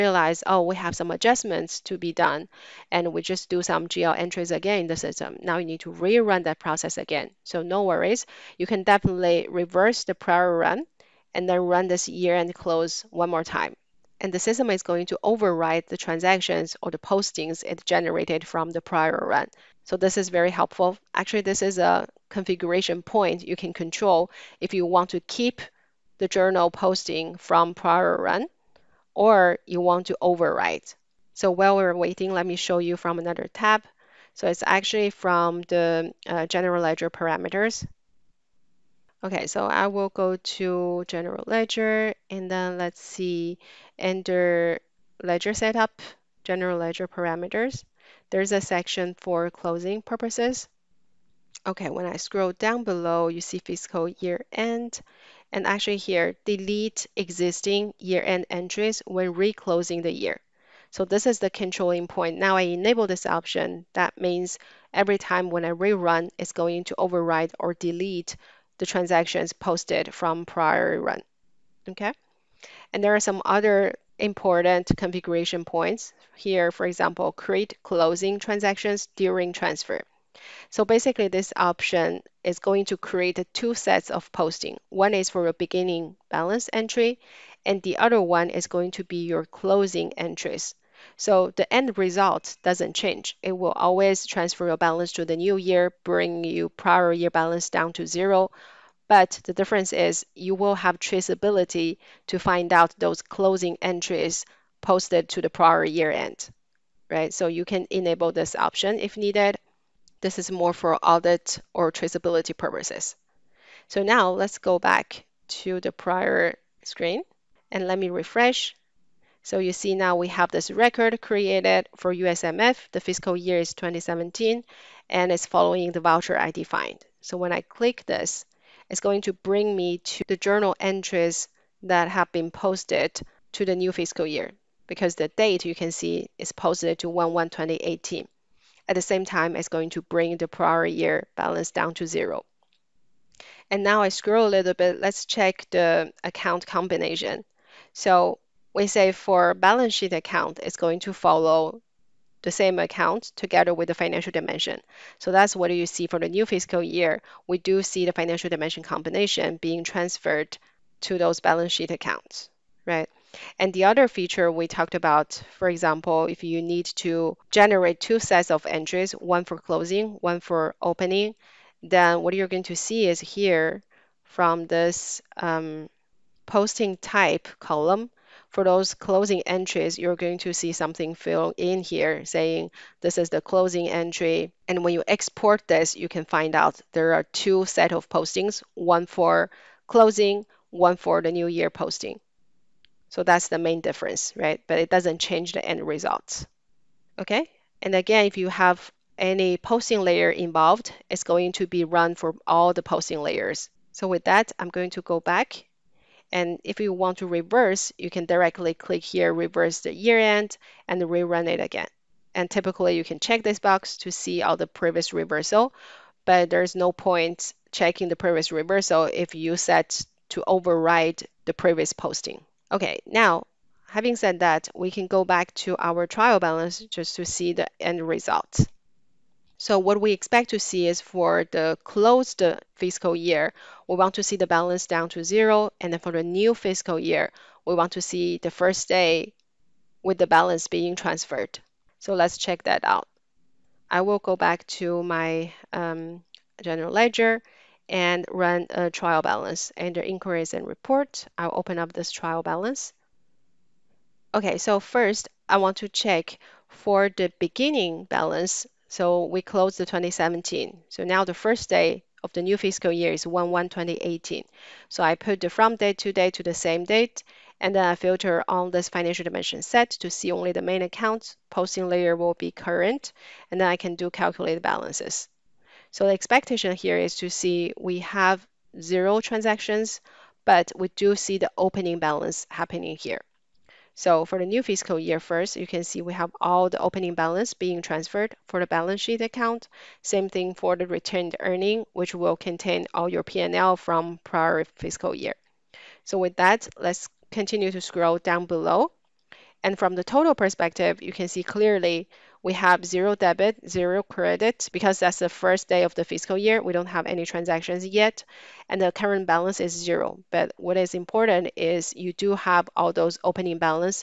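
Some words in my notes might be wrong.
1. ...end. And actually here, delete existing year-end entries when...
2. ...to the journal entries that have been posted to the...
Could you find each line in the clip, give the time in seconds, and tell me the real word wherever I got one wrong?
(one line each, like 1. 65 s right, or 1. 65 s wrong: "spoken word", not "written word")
1. 54 s right
2. 129 s right.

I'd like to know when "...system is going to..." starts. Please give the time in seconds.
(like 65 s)
14 s.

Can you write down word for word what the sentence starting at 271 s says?
Posting layer will be current, and then I can do calculate balances.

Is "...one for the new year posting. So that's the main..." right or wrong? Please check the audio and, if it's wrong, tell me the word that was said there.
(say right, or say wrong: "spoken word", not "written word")
right.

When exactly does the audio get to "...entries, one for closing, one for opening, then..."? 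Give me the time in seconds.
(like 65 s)
168 s.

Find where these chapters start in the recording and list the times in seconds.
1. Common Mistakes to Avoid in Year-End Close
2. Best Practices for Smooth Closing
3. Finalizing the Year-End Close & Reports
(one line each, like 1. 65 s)
1. 60 s
2. 173 s
3. 280 s.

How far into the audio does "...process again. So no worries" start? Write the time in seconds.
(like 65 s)
6 s.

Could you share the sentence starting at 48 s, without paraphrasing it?
There's a section for closing purposes.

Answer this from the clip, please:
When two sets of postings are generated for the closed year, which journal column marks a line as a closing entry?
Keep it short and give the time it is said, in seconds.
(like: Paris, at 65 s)
Posting type, at 176 s.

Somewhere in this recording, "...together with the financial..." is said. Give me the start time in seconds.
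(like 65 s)
153 s.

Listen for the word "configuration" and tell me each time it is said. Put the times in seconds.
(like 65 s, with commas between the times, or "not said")
22 s, 74 s.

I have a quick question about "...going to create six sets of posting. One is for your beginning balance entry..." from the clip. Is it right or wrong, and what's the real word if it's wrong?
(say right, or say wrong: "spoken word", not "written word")
wrong: "two", not "six".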